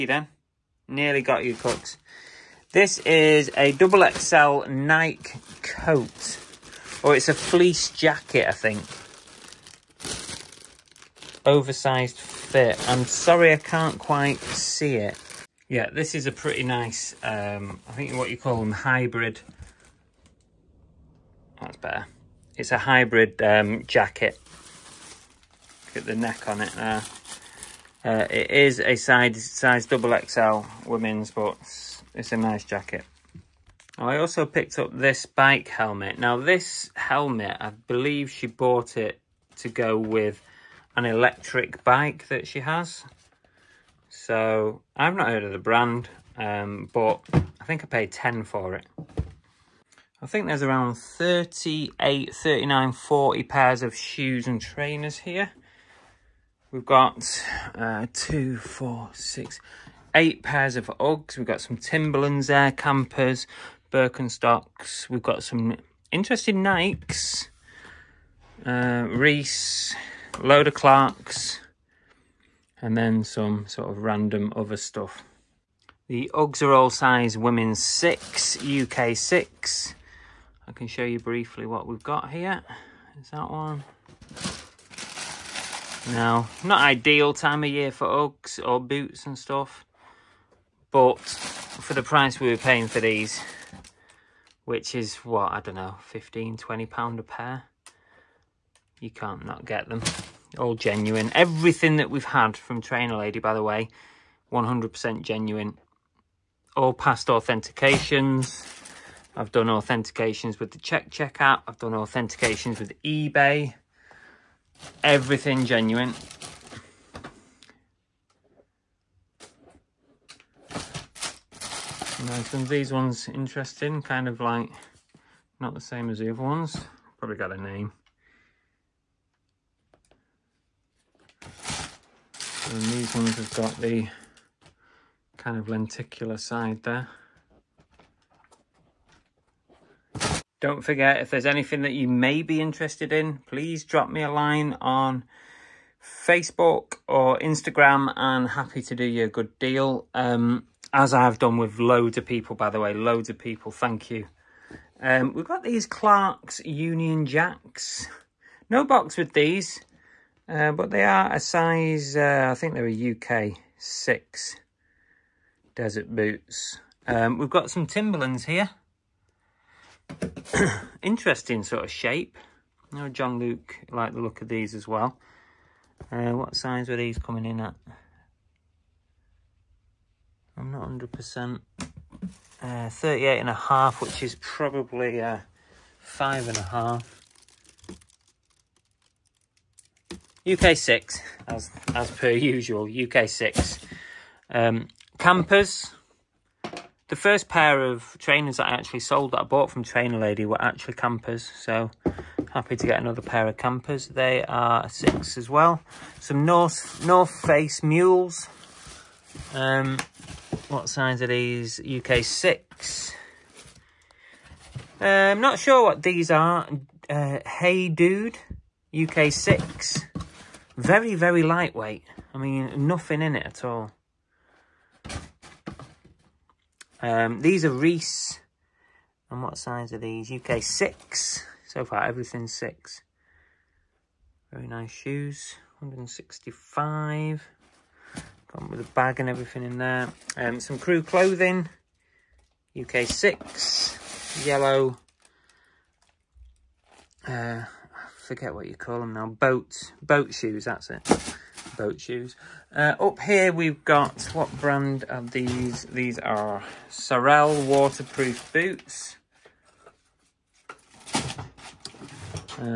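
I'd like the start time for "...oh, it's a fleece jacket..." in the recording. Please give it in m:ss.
0:07.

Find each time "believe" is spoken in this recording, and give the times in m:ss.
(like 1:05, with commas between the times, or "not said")
0:37.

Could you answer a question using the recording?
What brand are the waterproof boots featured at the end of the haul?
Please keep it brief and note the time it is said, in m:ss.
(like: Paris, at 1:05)
Sorel, at 4:16.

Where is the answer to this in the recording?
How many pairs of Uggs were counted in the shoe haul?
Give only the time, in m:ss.
1:00.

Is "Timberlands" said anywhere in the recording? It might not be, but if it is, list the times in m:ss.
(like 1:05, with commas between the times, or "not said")
1:01, 2:47.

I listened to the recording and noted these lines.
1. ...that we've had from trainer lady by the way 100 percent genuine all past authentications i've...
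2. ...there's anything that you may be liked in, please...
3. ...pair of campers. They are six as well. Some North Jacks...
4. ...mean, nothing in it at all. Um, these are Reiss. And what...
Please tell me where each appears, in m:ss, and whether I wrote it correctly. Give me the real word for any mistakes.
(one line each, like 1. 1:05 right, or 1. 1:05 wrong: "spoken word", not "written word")
1. 1:41 right
2. 2:21 wrong: "interested", not "liked"
3. 3:23 wrong: "North", not "Jacks"
4. 3:42 right.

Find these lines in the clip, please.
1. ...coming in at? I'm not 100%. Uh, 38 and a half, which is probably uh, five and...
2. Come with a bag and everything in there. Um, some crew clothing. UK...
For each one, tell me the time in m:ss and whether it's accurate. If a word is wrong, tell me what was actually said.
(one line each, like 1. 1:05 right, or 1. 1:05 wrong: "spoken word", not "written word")
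1. 2:57 right
2. 3:58 right.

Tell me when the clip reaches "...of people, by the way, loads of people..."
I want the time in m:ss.
2:32.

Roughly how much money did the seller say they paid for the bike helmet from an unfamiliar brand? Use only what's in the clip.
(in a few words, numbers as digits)
10.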